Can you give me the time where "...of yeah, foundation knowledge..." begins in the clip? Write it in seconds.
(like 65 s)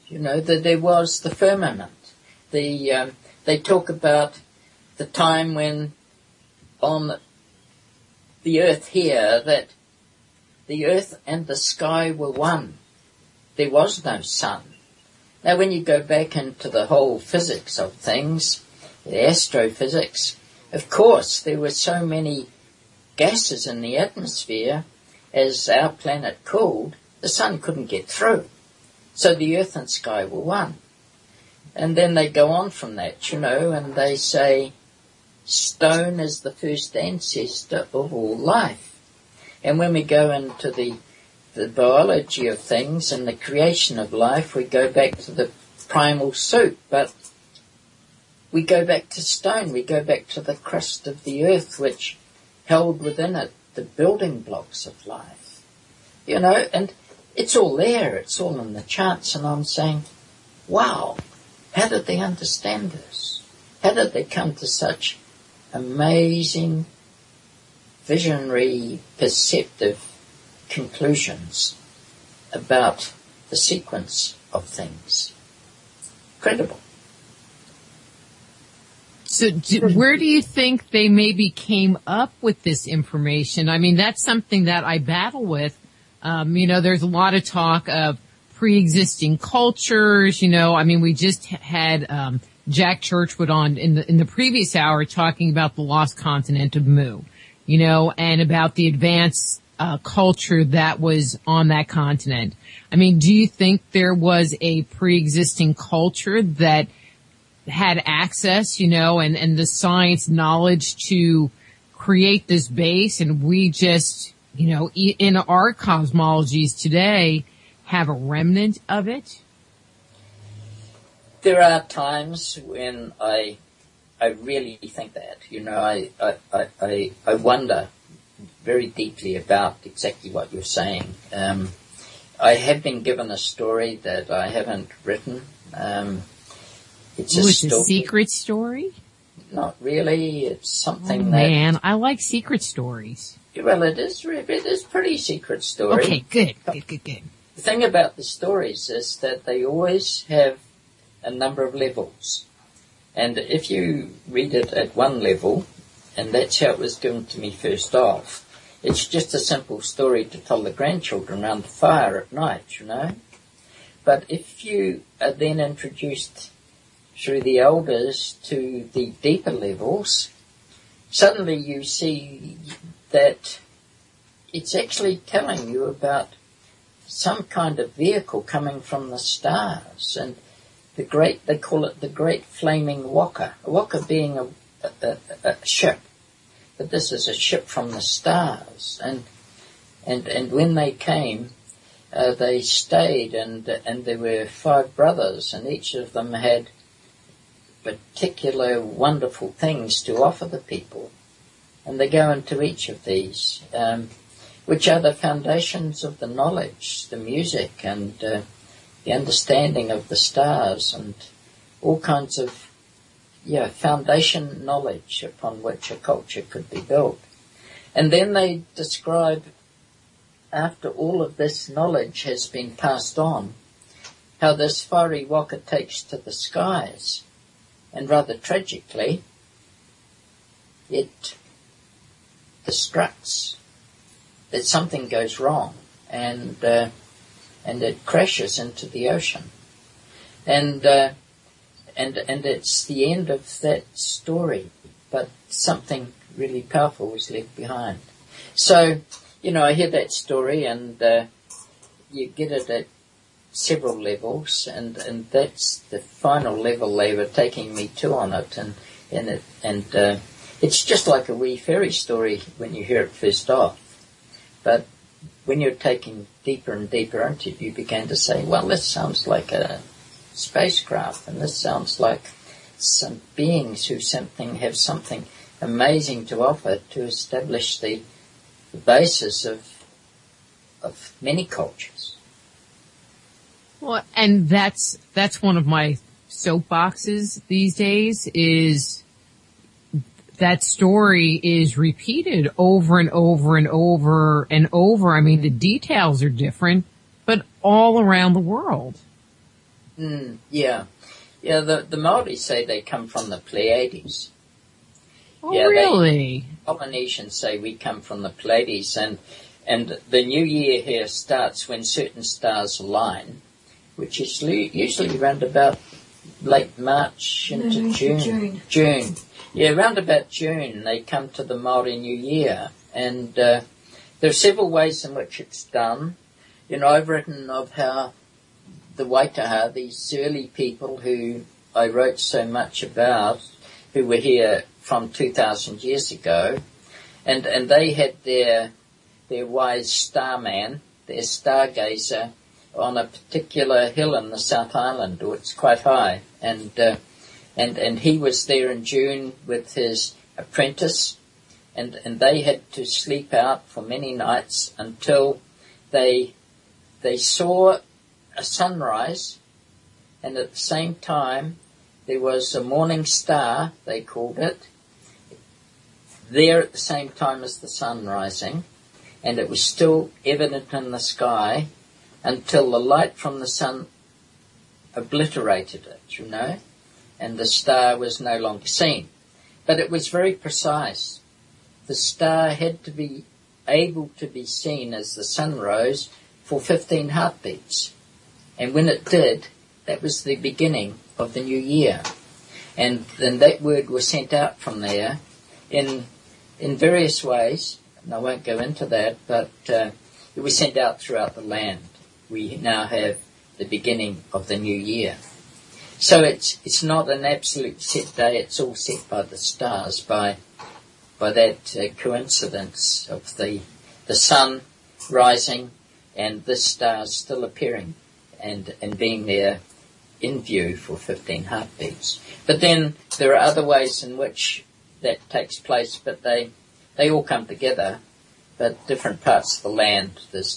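212 s.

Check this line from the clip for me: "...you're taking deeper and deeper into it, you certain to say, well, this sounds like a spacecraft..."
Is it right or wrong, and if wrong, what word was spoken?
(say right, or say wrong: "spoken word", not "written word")
wrong: "begin", not "certain".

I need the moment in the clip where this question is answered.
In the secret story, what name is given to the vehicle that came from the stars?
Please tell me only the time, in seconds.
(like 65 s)
182 s.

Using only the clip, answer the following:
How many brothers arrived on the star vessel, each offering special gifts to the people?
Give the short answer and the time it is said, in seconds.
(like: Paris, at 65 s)
5, at 194 s.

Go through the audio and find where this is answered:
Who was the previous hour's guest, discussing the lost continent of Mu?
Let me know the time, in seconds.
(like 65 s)
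92 s.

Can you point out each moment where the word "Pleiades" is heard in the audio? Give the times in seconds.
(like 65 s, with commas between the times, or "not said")
303 s, 308 s.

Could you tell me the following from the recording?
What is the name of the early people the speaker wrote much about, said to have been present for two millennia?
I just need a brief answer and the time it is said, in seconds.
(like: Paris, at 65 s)
Waitaha, at 329 s.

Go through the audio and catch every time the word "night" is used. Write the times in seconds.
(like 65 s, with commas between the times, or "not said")
162 s, 354 s.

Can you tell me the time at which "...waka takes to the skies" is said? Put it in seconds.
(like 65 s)
225 s.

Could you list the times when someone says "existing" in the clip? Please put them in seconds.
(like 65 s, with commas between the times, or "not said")
88 s, 104 s.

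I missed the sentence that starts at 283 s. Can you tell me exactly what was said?
Well, and that's that's one of my soapboxes these days is that story is repeated over and over and over and over.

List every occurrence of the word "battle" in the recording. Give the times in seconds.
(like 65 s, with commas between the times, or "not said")
84 s.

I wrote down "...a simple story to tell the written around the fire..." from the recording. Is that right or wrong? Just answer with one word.
wrong.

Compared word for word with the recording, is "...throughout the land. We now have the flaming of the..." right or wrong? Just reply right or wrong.
wrong.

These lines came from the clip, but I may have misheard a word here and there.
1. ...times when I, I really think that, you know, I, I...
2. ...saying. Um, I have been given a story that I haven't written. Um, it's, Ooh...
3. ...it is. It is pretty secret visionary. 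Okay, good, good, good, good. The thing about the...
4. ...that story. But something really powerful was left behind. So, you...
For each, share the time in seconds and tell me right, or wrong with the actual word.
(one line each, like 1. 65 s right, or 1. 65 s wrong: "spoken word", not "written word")
1. 121 s right
2. 130 s right
3. 143 s wrong: "story", not "visionary"
4. 243 s right.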